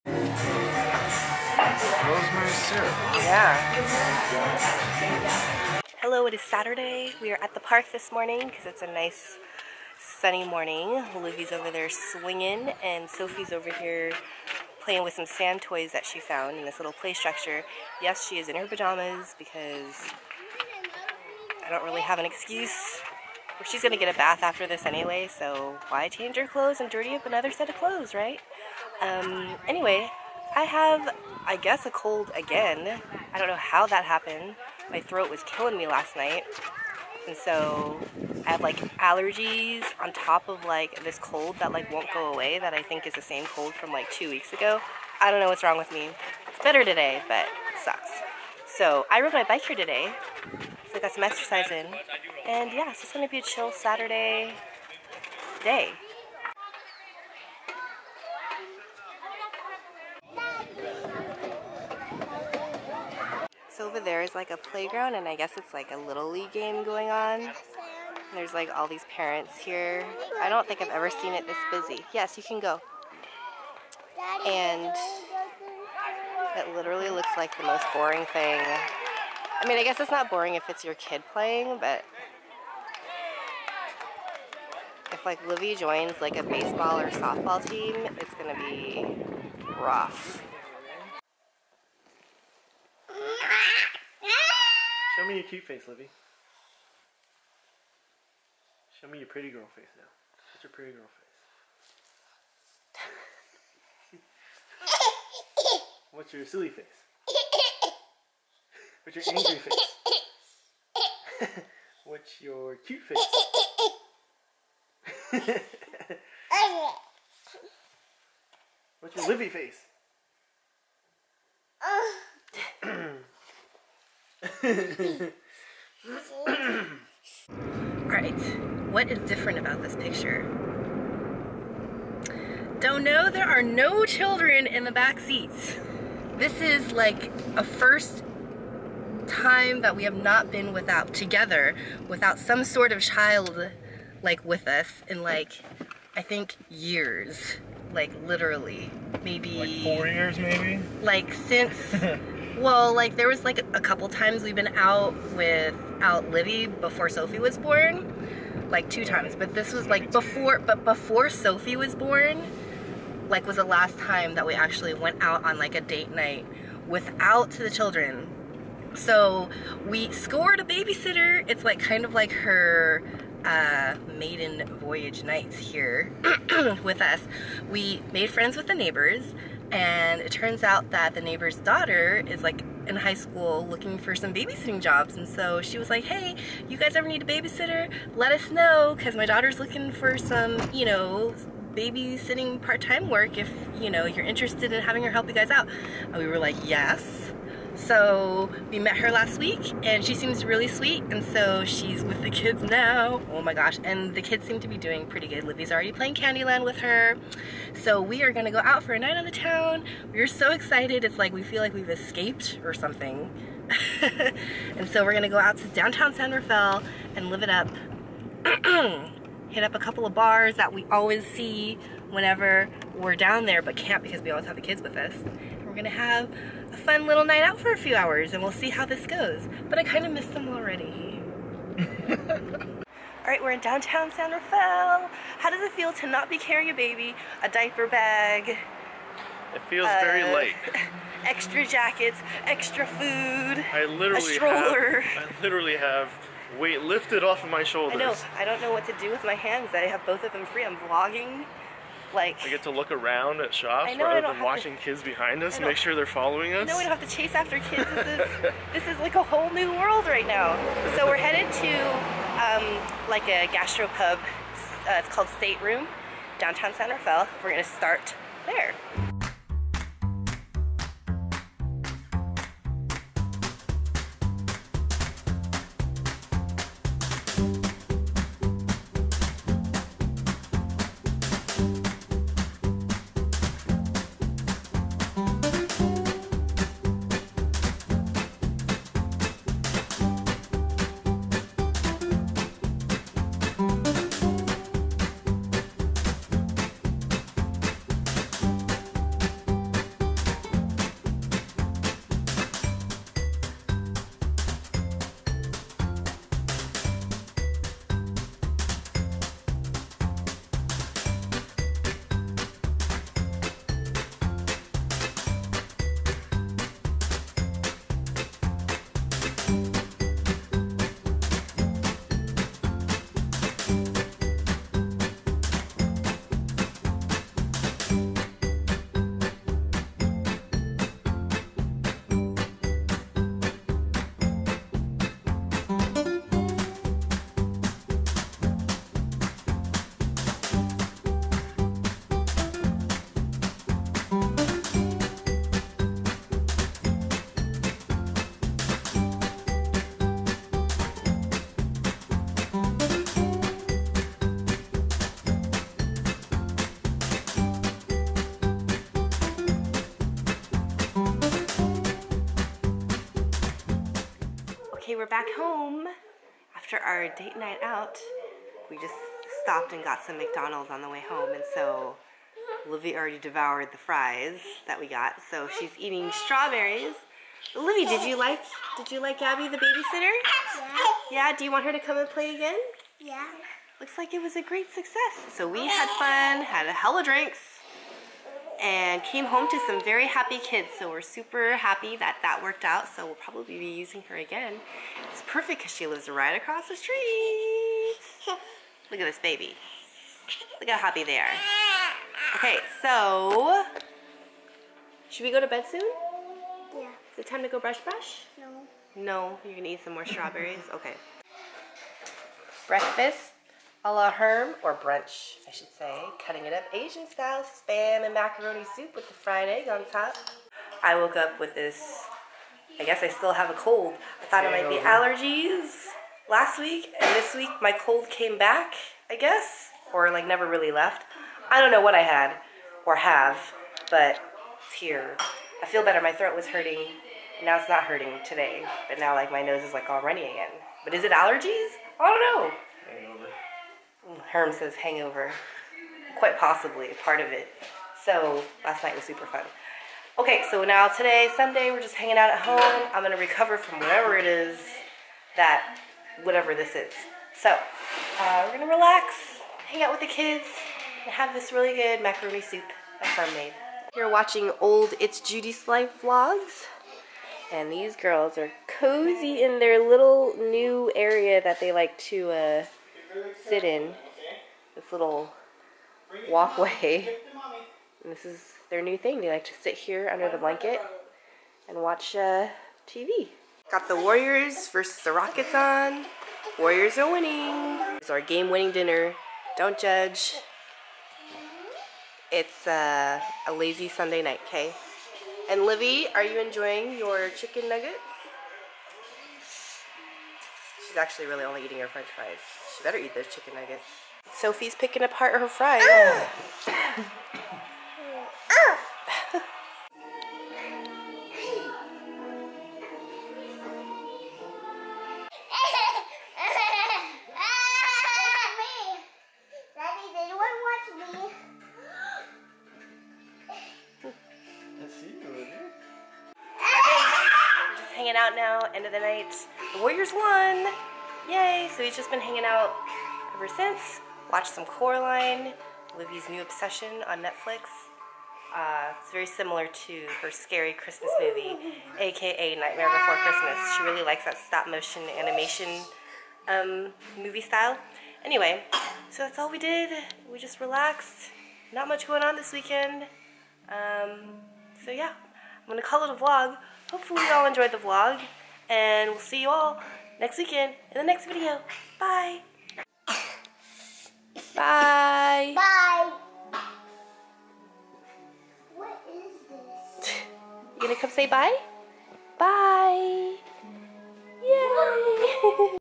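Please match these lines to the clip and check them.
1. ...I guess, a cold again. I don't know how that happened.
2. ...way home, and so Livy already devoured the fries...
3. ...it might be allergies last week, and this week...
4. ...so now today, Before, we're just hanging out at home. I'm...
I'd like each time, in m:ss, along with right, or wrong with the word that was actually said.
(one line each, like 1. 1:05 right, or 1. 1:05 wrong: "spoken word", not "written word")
1. 0:31 right
2. 6:10 right
3. 7:04 right
4. 7:30 wrong: "Sunday", not "Before".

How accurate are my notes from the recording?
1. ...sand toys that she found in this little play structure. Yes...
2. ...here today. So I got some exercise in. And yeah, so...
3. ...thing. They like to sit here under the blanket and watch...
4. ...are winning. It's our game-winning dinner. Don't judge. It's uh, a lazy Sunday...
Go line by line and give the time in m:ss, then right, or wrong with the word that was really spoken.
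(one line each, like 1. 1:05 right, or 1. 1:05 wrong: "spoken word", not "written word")
1. 0:15 right
2. 0:49 right
3. 7:58 right
4. 8:06 right.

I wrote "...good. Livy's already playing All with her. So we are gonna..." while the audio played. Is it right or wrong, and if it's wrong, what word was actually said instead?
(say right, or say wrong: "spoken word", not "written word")
wrong: "Candyland", not "All".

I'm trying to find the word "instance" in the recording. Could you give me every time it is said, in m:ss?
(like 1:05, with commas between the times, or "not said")
not said.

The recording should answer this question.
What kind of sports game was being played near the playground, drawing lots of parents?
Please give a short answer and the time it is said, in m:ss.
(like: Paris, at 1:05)
Little League, at 1:05.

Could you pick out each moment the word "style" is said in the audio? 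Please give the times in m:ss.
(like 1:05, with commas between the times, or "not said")
6:57, 9:07.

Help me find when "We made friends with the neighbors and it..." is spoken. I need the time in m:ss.
2:57.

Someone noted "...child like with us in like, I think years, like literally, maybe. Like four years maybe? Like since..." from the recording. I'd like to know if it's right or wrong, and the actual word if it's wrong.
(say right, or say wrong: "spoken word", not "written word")
right.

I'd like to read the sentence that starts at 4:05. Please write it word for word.
Have, I literally have weight lifted off of my shoulders.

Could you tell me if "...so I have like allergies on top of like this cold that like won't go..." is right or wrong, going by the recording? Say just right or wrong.
right.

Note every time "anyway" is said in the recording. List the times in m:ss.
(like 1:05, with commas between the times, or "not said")
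0:24, 0:29, 9:08.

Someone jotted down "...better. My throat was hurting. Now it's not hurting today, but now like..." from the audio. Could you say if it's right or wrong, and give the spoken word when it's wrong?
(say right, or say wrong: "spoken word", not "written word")
right.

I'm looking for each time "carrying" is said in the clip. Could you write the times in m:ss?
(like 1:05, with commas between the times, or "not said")
3:56.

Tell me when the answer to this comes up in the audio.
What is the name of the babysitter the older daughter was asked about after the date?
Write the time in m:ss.
6:19.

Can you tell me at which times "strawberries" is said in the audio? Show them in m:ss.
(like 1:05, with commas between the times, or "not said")
6:16, 6:50.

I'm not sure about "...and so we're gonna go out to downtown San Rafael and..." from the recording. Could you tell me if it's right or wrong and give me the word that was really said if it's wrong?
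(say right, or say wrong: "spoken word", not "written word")
right.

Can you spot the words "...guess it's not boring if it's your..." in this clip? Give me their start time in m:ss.
1:19.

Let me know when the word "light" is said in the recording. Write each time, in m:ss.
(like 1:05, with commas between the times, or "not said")
4:00.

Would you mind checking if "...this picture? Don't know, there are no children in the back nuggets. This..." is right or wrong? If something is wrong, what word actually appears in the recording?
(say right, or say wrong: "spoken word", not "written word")
wrong: "seats", not "nuggets".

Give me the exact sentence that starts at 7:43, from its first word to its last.
You're watching old It's Judy's Life vlogs.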